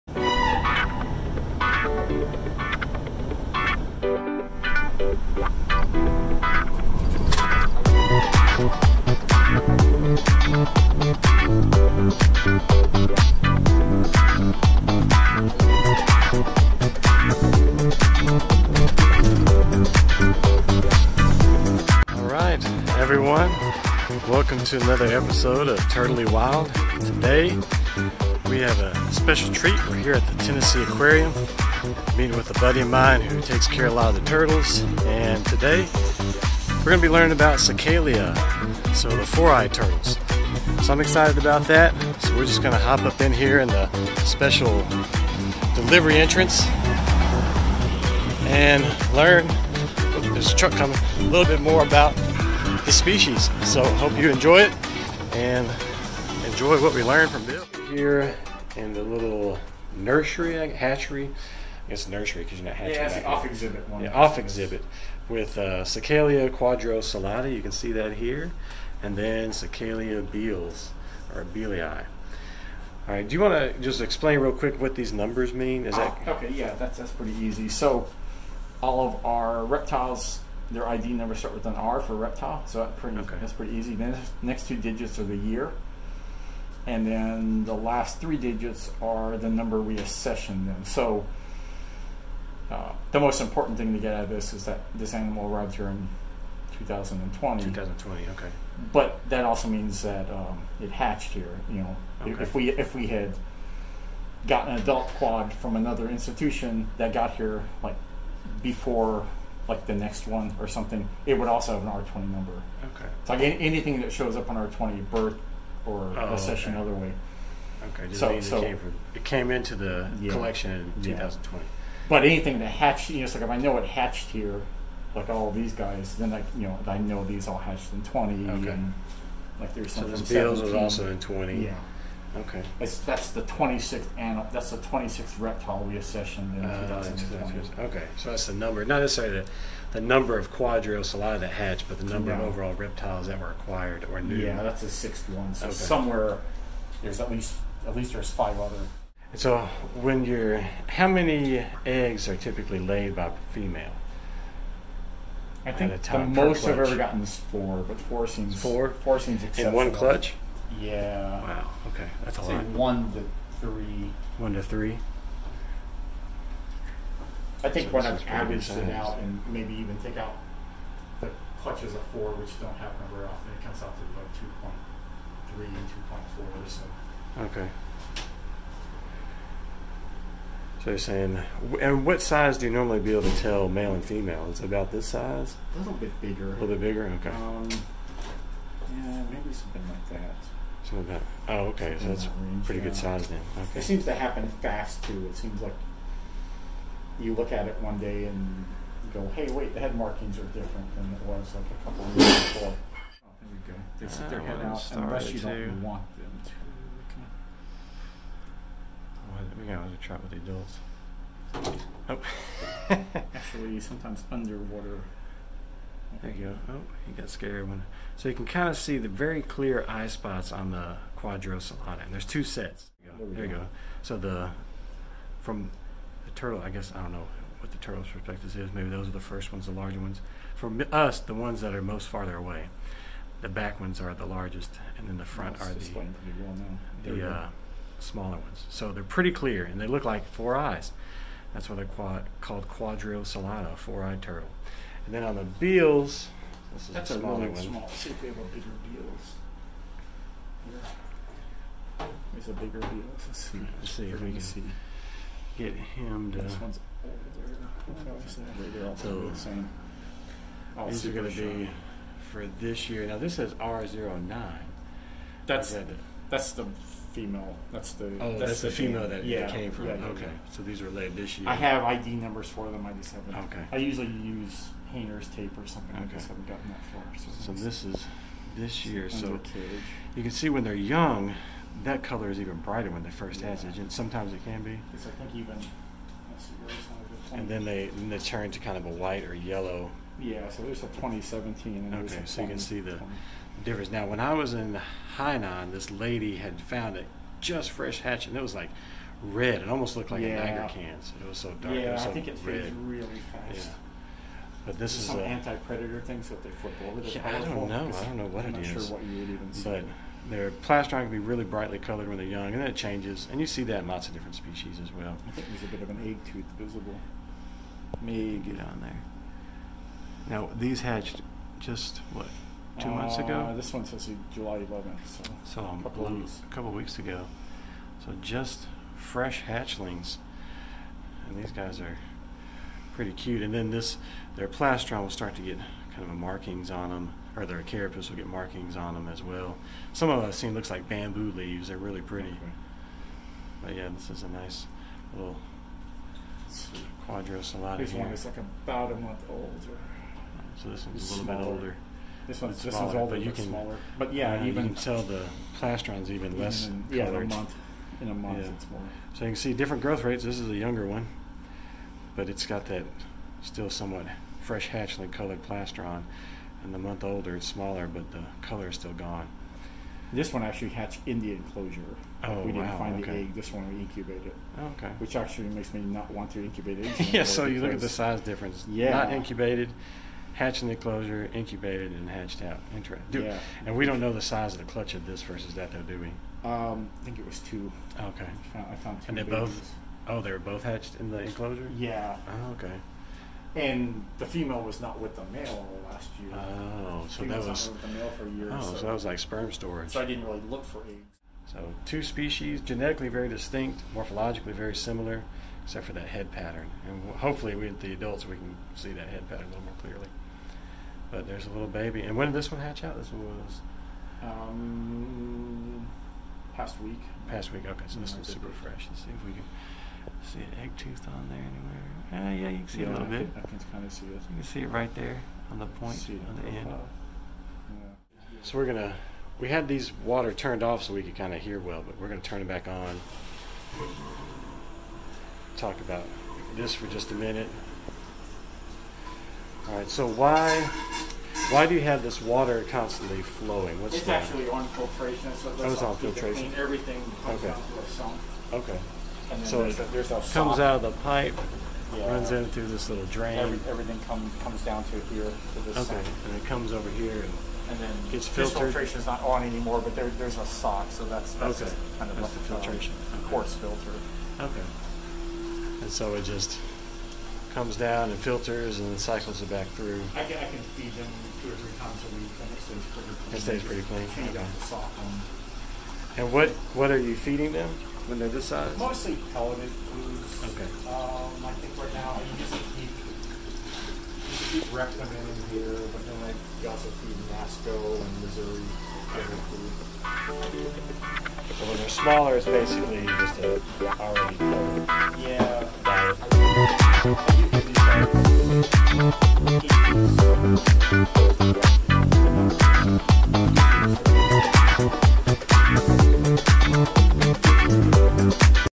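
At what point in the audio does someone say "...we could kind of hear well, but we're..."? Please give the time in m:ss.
7:10.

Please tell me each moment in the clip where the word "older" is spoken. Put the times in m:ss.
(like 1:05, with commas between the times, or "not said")
4:17, 5:51, 6:07.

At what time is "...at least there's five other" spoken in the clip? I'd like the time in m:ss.
2:27.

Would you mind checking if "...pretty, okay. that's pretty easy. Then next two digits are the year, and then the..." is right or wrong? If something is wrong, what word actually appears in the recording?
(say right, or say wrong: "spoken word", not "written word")
right.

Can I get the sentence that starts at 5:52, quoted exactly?
This one's this one's smaller, but you can, smaller.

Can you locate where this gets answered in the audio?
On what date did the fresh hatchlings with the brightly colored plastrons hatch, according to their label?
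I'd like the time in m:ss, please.
5:24.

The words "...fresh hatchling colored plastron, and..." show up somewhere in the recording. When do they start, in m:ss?
6:04.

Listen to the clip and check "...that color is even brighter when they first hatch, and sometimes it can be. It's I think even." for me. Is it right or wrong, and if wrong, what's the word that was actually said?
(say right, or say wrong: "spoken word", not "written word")
right.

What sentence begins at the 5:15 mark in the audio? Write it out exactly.
I think there's a bit of an egg tooth visible.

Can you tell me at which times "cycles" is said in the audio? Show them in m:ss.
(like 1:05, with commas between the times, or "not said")
7:48.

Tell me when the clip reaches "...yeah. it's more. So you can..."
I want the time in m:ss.
5:58.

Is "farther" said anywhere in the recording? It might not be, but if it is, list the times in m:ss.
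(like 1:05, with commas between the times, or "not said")
3:52.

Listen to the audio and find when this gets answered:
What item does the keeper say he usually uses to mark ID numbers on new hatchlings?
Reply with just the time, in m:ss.
4:34.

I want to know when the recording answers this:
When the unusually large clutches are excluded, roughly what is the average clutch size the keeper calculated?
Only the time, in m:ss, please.
2:55.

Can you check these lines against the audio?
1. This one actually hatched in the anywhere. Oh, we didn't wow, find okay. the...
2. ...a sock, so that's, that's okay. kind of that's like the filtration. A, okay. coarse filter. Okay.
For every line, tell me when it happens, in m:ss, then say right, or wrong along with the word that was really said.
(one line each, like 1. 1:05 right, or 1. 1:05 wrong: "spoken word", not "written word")
1. 6:10 wrong: "enclosure", not "anywhere"
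2. 7:40 right.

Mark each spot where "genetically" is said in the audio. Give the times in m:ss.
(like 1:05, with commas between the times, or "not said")
6:42.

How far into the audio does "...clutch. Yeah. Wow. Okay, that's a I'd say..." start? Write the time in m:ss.
2:39.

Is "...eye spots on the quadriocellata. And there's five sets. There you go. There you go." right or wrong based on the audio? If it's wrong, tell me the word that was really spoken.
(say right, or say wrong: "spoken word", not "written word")
wrong: "two", not "five".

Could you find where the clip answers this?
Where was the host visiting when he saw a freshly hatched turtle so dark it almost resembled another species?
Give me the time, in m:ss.
4:55.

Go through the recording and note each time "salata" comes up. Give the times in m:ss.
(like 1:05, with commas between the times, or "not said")
1:06.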